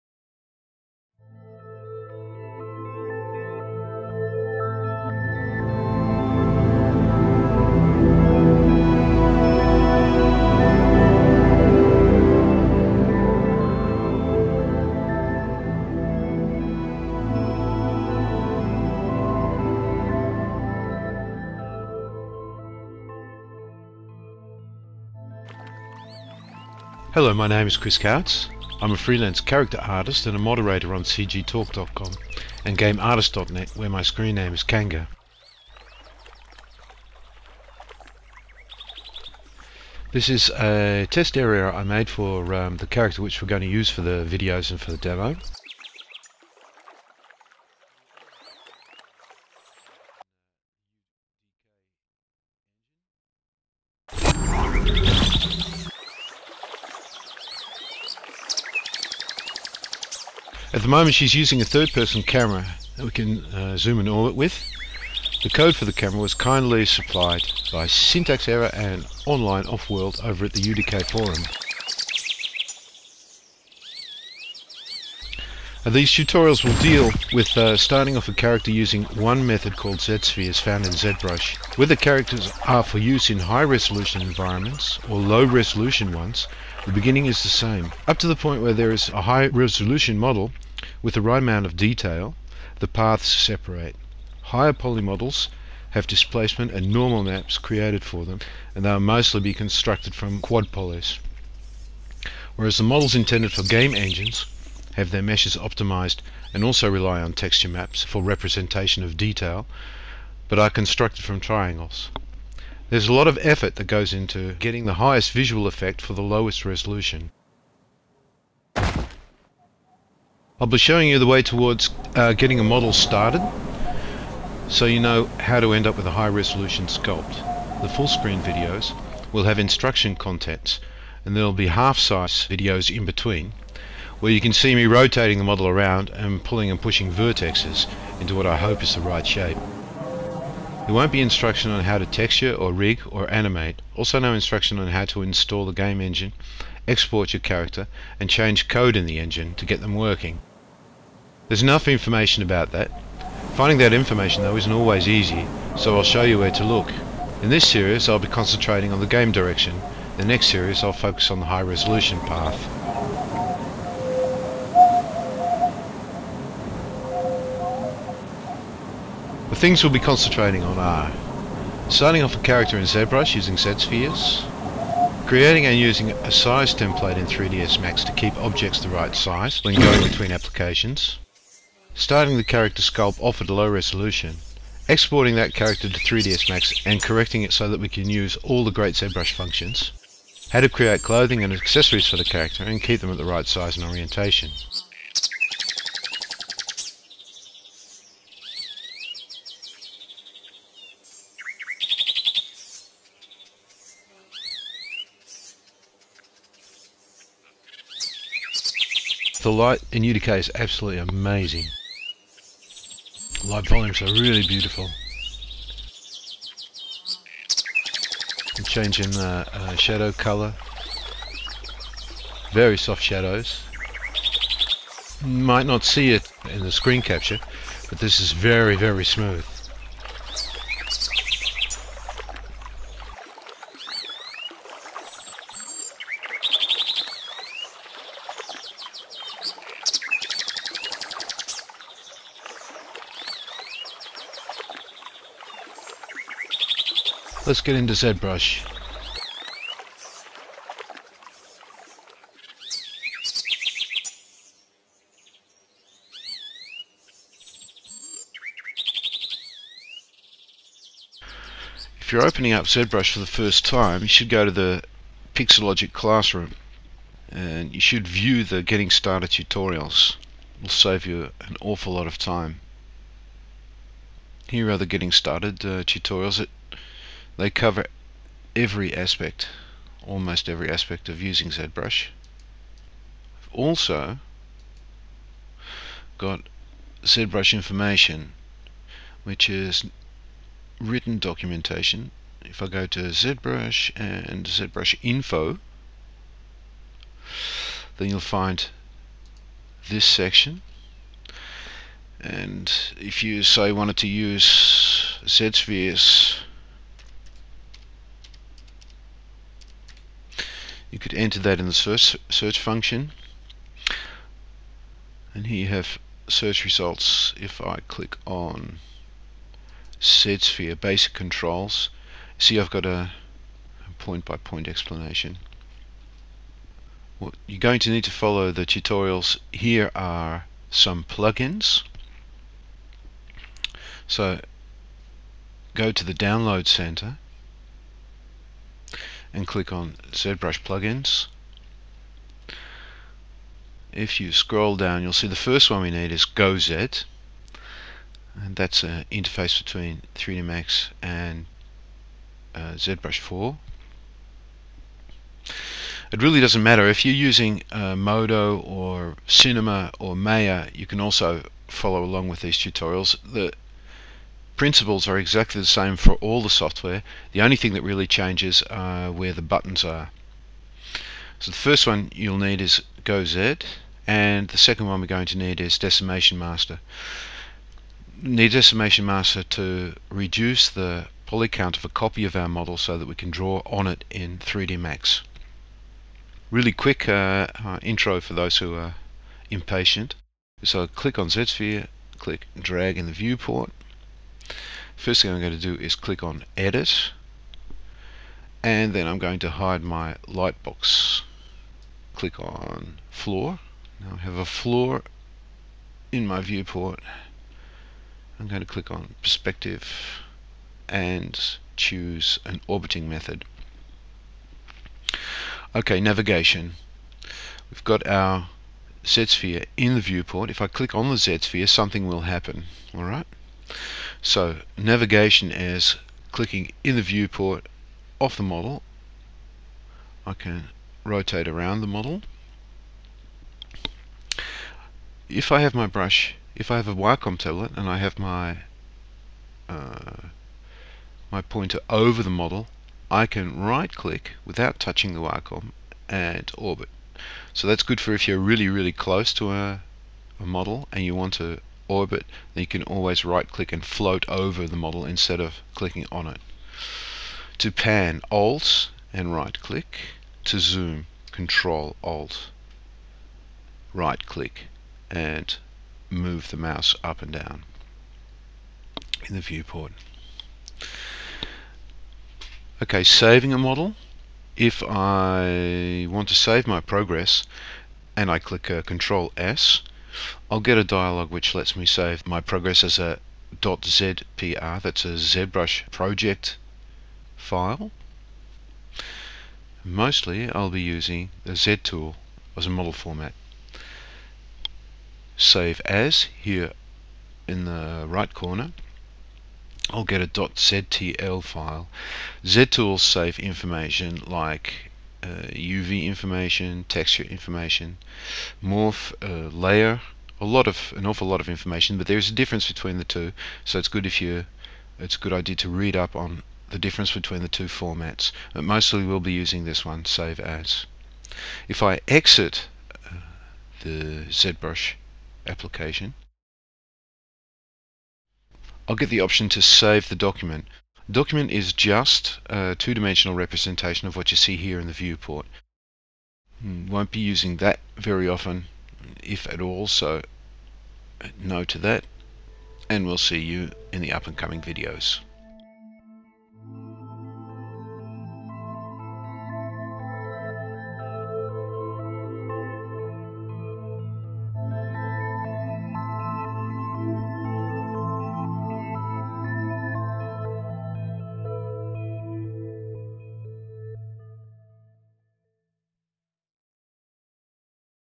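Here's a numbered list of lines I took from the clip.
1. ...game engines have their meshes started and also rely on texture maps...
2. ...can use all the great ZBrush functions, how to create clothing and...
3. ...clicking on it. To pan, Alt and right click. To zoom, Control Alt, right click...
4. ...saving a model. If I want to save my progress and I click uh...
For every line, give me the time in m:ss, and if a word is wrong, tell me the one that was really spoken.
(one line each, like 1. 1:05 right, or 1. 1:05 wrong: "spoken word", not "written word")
1. 1:43 wrong: "optimized", not "started"
2. 3:07 right
3. 7:35 right
4. 7:53 right.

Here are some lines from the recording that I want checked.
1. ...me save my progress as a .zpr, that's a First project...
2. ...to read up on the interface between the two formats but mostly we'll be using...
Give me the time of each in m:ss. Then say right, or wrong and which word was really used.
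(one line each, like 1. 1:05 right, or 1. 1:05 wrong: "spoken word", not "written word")
1. 8:01 wrong: "ZBrush", not "First"
2. 8:35 wrong: "difference", not "interface".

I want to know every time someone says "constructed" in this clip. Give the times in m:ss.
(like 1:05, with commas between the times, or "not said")
1:39, 1:50.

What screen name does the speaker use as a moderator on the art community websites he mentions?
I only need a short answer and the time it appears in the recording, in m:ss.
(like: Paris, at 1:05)
Kanga, at 0:34.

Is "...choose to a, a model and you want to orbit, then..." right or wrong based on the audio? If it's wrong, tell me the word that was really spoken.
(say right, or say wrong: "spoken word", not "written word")
wrong: "close", not "choose".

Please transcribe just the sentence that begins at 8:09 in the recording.
Mostly I'll be using the Z tool as a model format.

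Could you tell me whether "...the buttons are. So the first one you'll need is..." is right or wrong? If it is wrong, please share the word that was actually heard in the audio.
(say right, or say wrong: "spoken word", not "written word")
right.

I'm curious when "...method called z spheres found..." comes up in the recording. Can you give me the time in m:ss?
1:19.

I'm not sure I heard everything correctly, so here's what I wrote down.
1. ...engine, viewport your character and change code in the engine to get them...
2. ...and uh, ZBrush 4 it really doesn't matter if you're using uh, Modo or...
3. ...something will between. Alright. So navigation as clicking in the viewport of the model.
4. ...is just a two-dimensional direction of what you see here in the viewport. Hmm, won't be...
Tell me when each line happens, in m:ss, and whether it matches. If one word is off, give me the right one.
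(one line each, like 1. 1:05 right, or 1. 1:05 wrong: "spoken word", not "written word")
1. 2:26 wrong: "export", not "viewport"
2. 5:51 right
3. 7:01 wrong: "happen", not "between"
4. 8:51 wrong: "representation", not "direction".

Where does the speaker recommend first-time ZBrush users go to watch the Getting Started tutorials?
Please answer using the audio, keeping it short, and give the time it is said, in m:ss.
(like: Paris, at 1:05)
Pixologic Classroom, at 4:25.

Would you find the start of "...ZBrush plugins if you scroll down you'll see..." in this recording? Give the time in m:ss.
5:40.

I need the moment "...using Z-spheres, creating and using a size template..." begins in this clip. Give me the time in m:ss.
2:53.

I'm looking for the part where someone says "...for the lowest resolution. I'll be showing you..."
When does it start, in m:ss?
1:56.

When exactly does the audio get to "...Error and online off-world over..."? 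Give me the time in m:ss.
1:08.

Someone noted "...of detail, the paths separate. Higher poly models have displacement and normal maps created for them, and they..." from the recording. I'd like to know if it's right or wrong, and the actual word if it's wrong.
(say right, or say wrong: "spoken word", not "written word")
right.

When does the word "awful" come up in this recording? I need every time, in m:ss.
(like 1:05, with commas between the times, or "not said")
4:31, 8:31.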